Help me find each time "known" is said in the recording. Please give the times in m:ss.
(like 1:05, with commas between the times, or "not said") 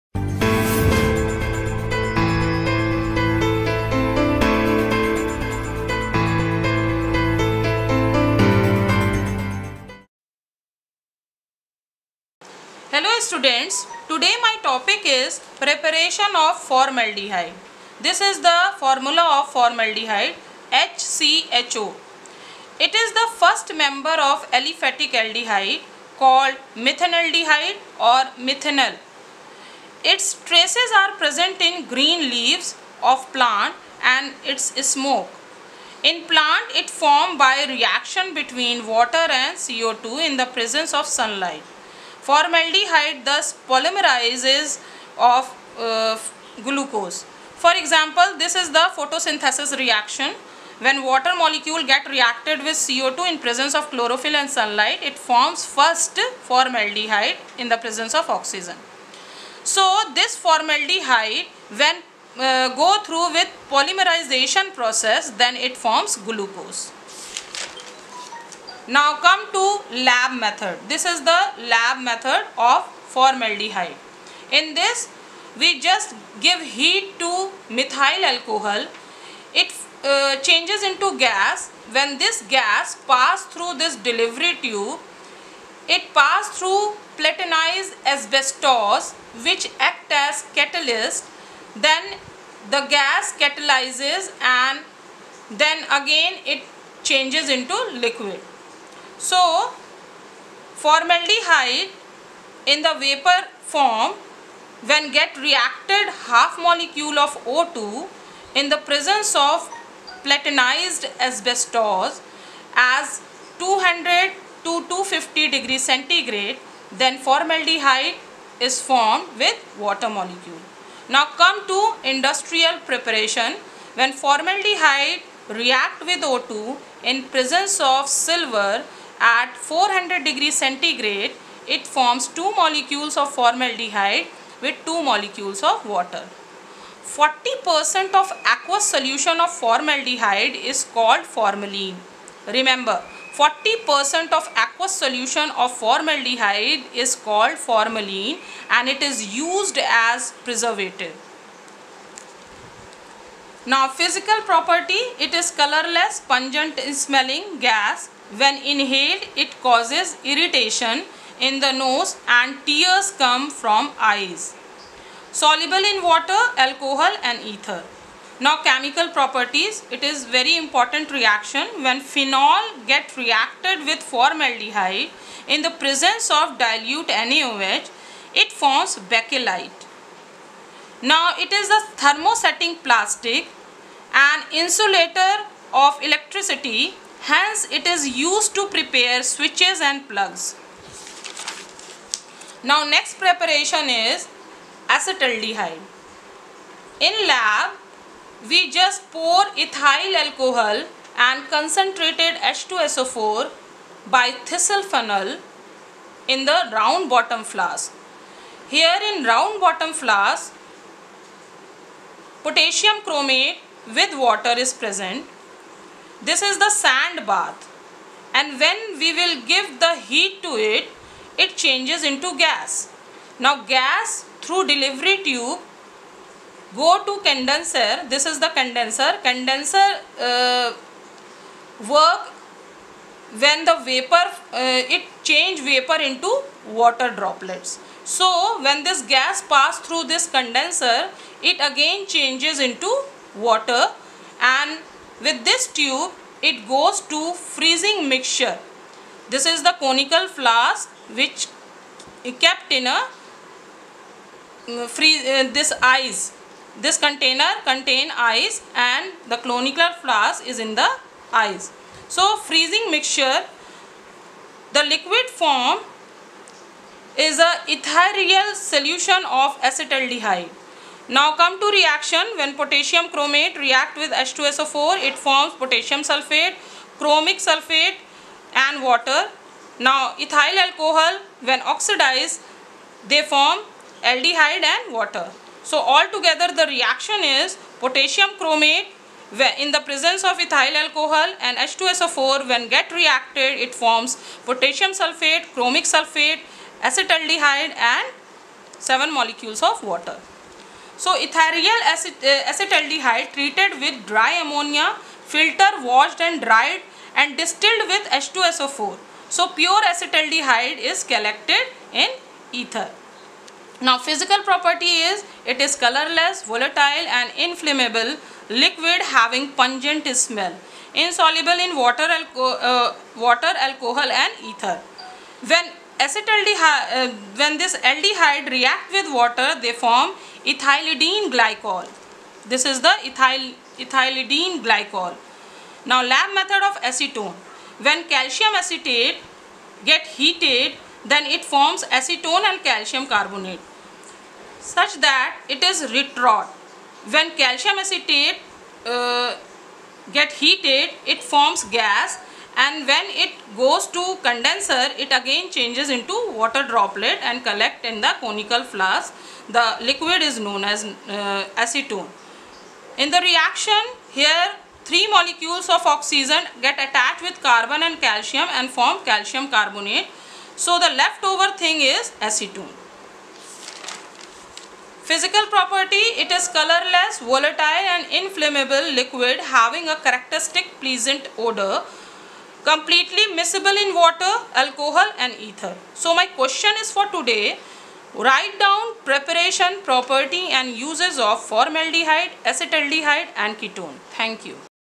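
6:00.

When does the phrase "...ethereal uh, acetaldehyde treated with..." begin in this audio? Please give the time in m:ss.
5:01.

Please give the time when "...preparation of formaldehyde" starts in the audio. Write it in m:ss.
0:15.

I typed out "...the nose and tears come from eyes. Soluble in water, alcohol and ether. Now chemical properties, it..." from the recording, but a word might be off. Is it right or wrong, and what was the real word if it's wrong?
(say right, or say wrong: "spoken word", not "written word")
right.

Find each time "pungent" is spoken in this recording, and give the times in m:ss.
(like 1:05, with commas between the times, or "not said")
2:36, 5:19.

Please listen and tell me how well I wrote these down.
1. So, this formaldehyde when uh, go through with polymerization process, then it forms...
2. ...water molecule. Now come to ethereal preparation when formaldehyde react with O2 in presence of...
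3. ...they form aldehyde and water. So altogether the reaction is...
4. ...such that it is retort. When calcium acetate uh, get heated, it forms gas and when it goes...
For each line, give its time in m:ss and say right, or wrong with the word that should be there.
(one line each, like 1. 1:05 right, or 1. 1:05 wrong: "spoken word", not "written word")
1. 0:59 right
2. 1:59 wrong: "industrial", not "ethereal"
3. 4:43 right
4. 5:44 right.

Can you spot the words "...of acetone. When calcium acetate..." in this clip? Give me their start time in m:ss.
5:36.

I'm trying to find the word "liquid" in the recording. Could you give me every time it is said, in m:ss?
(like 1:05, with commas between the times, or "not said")
1:38, 4:24, 5:18, 5:59, 6:18.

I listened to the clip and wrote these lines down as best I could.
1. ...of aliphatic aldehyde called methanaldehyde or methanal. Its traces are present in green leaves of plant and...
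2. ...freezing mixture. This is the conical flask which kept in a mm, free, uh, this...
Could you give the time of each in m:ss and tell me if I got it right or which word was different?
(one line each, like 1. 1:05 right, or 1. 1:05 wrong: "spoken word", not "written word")
1. 0:24 right
2. 4:07 right.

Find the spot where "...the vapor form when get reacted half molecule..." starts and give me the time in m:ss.
1:42.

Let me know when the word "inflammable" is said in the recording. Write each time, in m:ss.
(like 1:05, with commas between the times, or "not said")
5:17, 6:18.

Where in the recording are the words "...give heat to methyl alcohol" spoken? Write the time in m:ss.
1:16.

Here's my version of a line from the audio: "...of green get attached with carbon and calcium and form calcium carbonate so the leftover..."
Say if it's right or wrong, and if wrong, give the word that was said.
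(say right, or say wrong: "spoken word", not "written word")
wrong: "oxygen", not "green".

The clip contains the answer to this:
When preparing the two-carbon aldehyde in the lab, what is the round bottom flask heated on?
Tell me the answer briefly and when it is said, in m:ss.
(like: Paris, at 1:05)
sand bath, at 3:36.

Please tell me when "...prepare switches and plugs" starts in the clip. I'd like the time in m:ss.
3:08.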